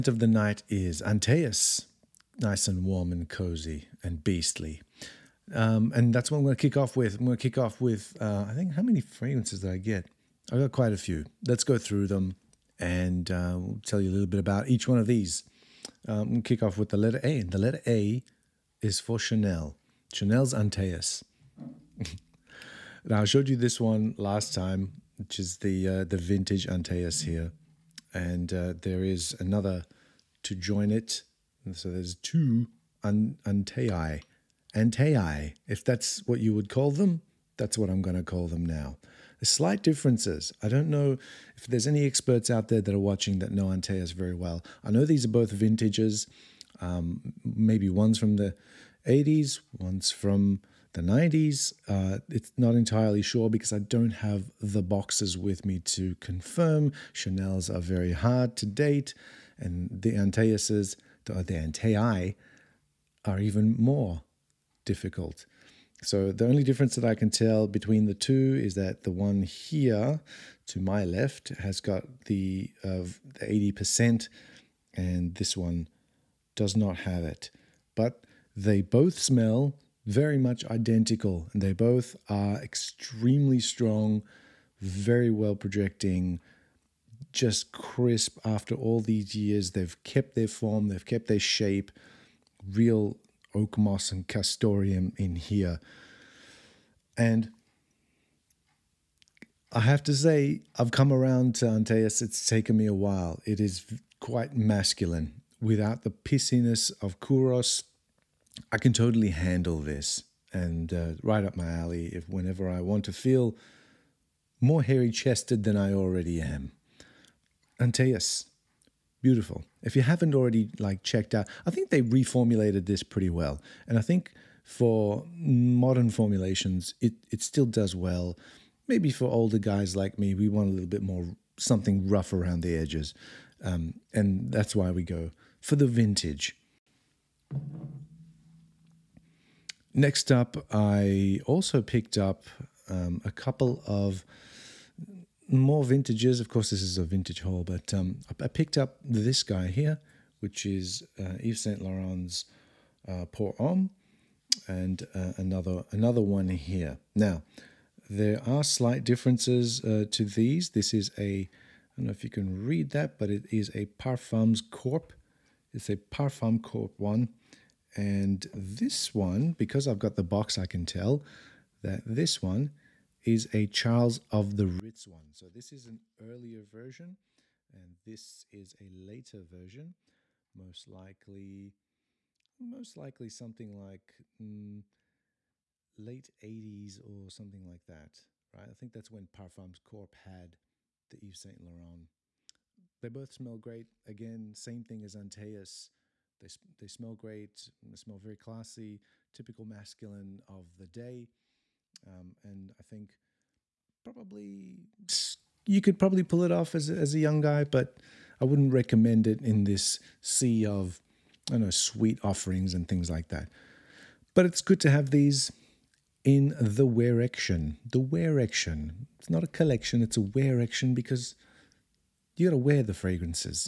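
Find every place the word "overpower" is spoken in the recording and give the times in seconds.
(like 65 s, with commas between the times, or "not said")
not said.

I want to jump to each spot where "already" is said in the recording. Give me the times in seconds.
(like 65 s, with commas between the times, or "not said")
115 s, 120 s.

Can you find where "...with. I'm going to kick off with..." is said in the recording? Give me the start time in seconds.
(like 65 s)
6 s.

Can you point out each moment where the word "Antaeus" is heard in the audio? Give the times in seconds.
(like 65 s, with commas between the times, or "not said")
1 s, 20 s, 26 s, 101 s, 117 s, 195 s.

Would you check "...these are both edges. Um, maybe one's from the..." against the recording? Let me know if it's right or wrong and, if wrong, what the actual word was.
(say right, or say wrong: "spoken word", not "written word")
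wrong: "vintages", not "edges".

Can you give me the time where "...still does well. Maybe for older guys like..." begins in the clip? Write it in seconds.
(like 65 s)
127 s.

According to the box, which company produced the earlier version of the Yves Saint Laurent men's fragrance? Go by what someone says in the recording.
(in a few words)
Charles of the Ritz.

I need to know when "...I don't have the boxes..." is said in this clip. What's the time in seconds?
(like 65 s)
53 s.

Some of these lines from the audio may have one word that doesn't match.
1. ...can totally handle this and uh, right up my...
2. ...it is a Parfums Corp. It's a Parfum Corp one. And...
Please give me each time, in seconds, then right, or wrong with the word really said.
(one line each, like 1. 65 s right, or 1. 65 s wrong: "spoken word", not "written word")
1. 108 s right
2. 163 s right.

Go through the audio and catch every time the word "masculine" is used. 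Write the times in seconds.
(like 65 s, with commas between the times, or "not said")
104 s, 199 s.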